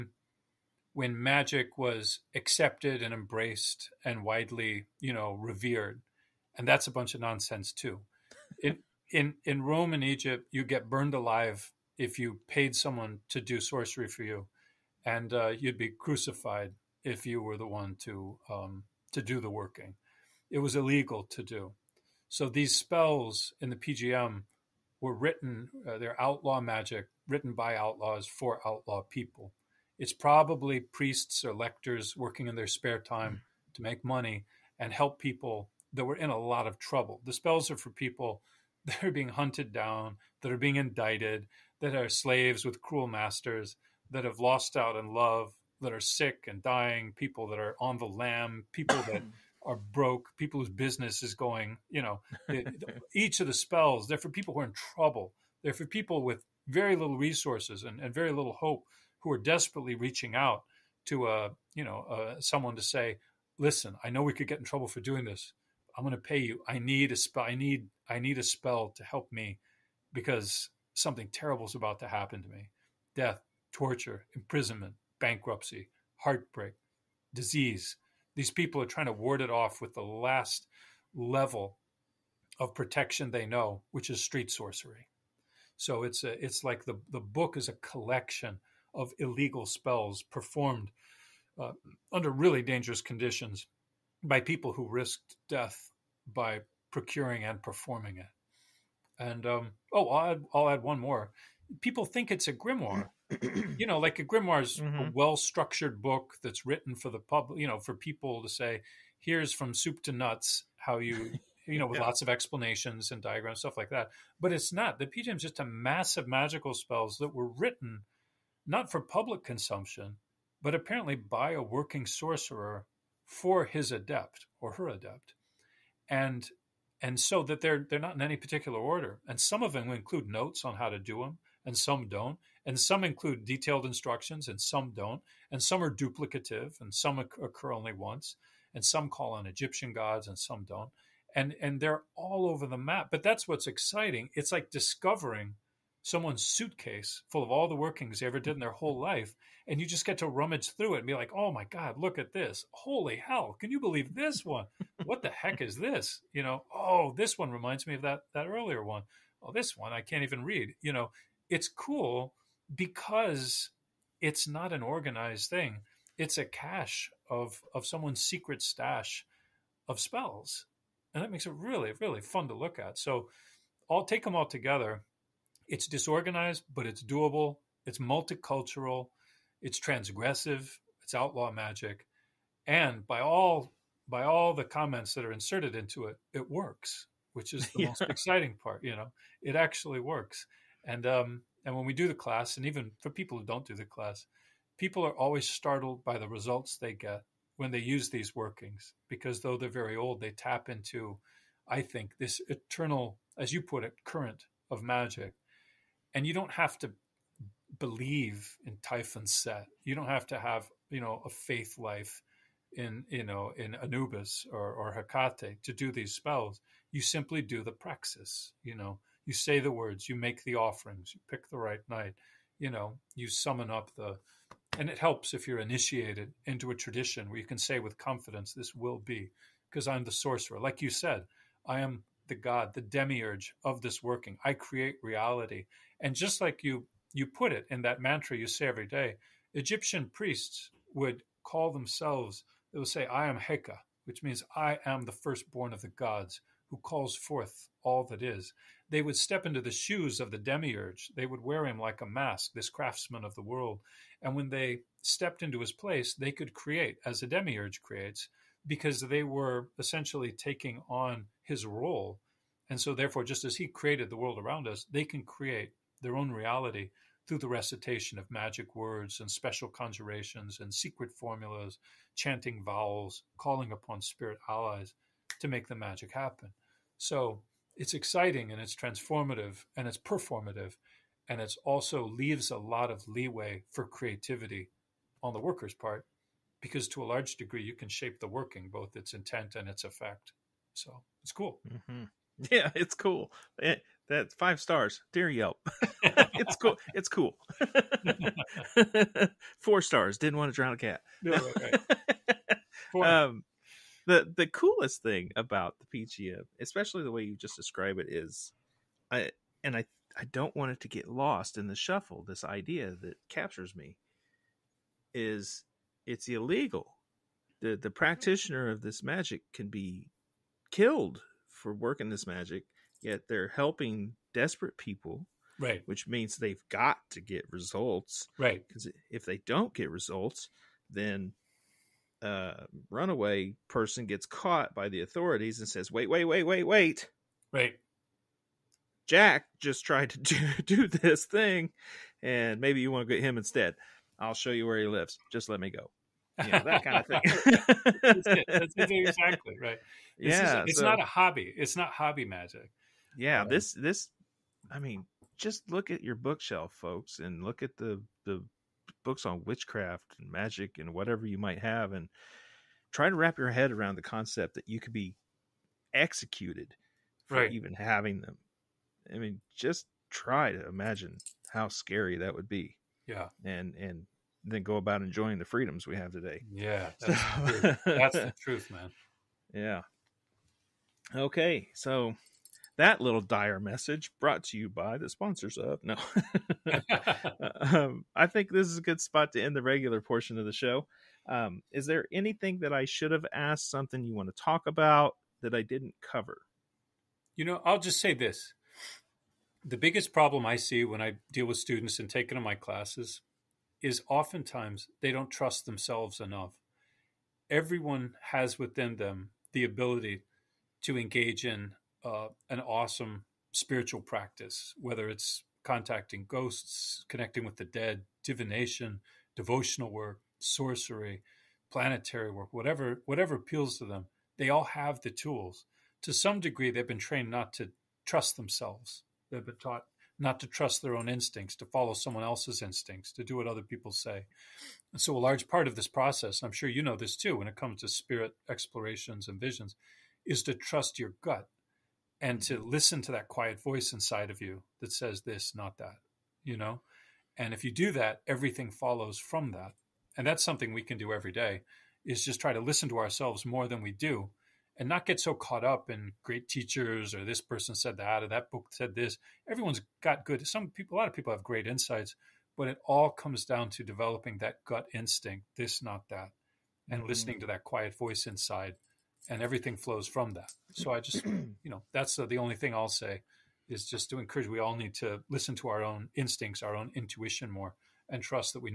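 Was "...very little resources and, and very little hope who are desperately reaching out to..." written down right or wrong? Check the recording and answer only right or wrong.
right.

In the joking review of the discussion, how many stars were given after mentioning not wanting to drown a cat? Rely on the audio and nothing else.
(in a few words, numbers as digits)
4.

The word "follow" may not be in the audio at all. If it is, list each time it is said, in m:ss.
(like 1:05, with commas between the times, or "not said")
7:11, 7:28.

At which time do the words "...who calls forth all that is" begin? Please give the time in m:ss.
4:06.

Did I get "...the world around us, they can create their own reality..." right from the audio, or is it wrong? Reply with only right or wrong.
right.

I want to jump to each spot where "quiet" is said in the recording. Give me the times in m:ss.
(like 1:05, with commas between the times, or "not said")
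7:23, 7:47.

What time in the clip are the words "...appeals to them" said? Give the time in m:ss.
7:03.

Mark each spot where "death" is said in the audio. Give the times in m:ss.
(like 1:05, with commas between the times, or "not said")
1:13, 1:35.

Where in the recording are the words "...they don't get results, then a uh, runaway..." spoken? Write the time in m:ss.
5:29.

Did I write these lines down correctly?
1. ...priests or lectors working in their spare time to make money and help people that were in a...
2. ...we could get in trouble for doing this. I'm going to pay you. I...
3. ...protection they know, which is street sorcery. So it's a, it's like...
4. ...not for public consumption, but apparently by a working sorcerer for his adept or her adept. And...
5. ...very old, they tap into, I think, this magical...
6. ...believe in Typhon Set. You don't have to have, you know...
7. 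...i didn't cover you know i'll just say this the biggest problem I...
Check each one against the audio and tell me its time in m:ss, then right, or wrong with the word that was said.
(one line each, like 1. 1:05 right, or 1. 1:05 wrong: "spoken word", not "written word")
1. 0:30 right
2. 1:04 right
3. 1:22 right
4. 1:58 right
5. 3:19 wrong: "eternal", not "magical"
6. 3:27 right
7. 6:35 right.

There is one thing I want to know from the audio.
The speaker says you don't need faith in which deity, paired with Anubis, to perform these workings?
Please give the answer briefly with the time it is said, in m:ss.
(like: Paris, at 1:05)
Hekate, at 3:34.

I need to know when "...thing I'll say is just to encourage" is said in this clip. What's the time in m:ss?
7:52.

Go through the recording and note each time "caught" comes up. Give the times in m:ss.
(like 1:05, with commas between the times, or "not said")
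5:34, 7:35.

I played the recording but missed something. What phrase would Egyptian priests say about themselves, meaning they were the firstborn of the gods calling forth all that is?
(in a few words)
I am Heka.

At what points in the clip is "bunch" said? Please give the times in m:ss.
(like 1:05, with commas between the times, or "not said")
0:06.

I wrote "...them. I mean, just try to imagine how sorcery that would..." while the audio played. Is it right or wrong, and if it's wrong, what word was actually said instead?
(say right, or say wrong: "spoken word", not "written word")
wrong: "scary", not "sorcery".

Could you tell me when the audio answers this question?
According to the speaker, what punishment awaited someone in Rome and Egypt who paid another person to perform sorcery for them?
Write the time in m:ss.
0:10.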